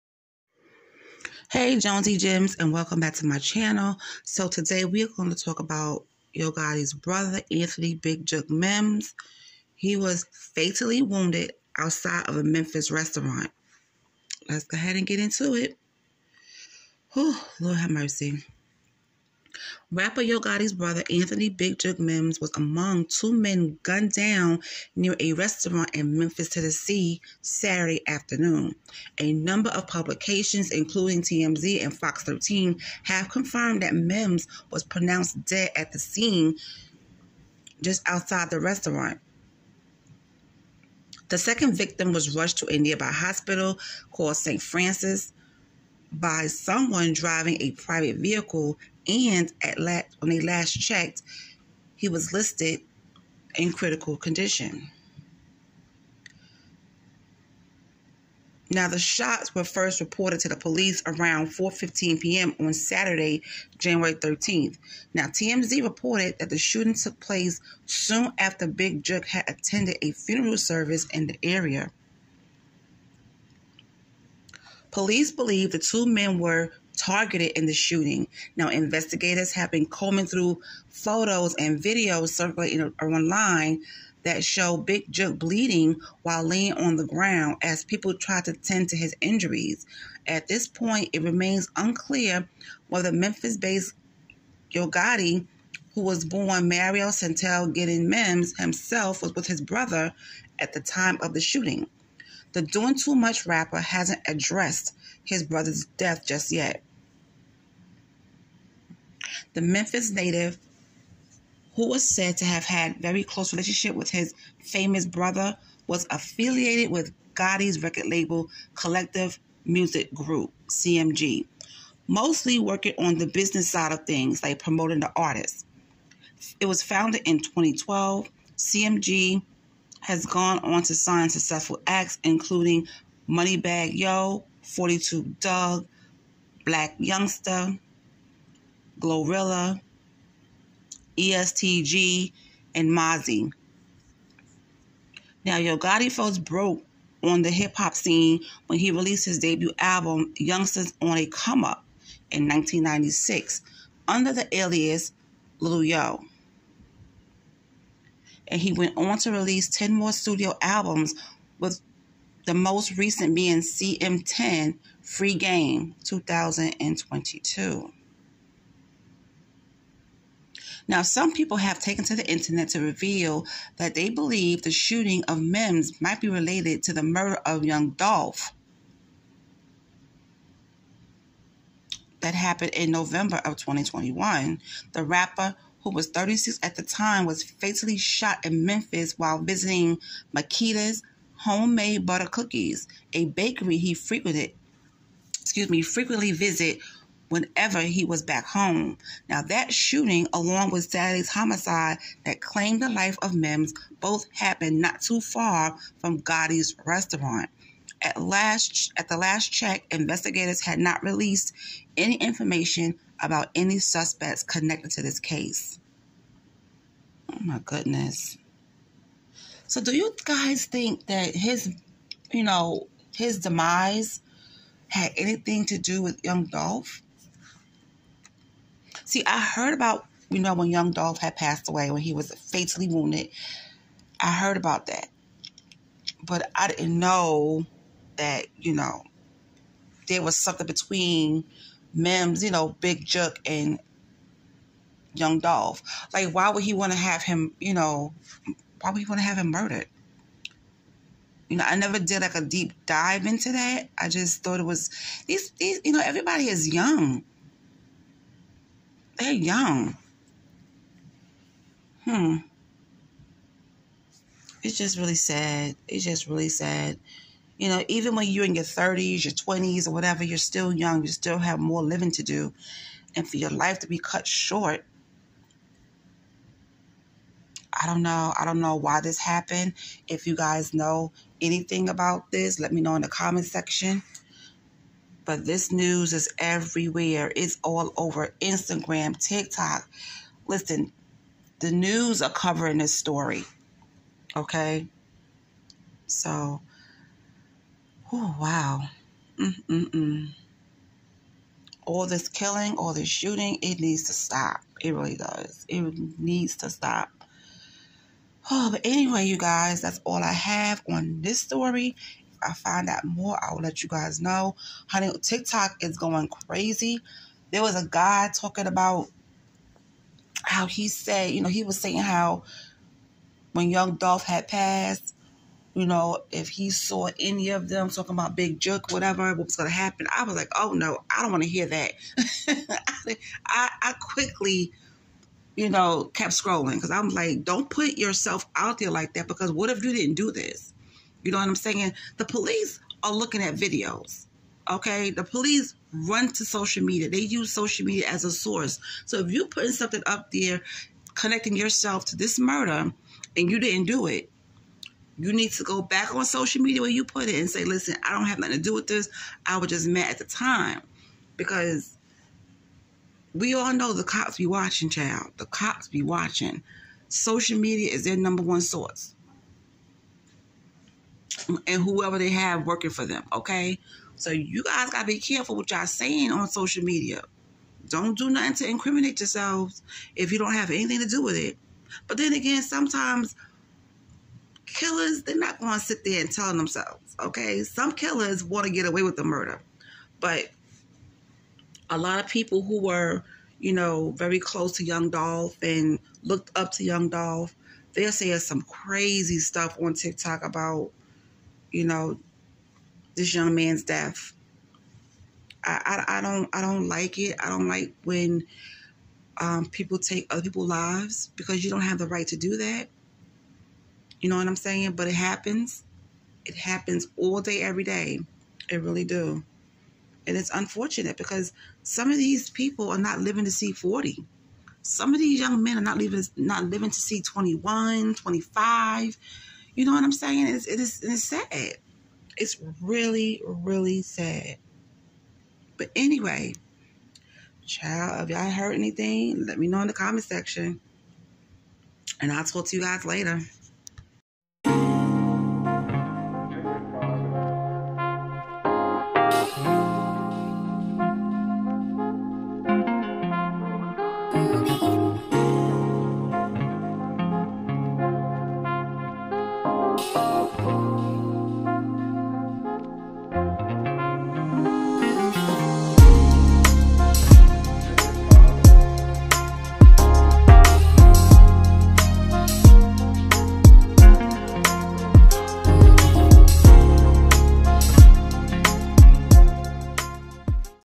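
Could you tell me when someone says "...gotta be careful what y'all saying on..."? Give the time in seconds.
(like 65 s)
374 s.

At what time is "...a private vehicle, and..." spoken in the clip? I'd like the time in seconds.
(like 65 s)
47 s.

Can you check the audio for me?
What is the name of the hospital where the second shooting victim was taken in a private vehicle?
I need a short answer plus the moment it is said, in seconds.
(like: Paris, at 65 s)
St. Francis, at 44 s.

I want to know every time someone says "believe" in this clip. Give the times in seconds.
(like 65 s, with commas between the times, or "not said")
75 s, 174 s.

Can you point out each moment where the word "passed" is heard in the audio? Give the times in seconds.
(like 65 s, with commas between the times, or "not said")
231 s, 324 s.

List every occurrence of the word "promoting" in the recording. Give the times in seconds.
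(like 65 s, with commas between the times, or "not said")
124 s.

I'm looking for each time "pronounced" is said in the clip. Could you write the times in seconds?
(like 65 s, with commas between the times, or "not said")
34 s.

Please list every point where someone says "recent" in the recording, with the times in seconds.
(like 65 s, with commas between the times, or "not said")
162 s.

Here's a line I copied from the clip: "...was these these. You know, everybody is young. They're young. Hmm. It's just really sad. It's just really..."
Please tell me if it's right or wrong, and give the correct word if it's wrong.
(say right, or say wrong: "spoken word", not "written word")
right.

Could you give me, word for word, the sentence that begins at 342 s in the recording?
The police are looking at videos.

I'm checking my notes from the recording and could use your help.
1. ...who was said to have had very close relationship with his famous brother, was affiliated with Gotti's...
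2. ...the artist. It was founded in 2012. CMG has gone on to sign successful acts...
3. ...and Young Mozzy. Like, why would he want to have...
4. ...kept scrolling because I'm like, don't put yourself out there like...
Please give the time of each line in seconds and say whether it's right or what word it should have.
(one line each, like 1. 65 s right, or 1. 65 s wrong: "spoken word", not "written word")
1. 111 s right
2. 124 s right
3. 243 s wrong: "Dolph", not "Mozzy"
4. 336 s right.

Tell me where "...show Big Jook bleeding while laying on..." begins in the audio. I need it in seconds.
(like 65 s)
84 s.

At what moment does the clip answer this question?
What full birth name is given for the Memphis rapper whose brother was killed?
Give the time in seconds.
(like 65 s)
96 s.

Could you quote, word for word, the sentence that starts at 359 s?
I was just mad at the time because we all know the cops be watching, child.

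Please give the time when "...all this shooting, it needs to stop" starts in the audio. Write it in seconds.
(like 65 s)
302 s.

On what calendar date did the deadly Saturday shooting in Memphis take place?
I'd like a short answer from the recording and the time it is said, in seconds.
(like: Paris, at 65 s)
January 13th, at 63 s.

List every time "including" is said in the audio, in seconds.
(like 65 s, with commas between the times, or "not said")
30 s, 132 s.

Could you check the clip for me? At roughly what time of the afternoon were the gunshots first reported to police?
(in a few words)
4:15 p.m.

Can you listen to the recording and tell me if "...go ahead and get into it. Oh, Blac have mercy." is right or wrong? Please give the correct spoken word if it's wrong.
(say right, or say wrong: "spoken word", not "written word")
wrong: "Lord", not "Blac".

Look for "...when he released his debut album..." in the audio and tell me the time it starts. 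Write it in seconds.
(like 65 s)
148 s.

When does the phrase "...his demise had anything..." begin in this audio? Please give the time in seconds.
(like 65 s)
223 s.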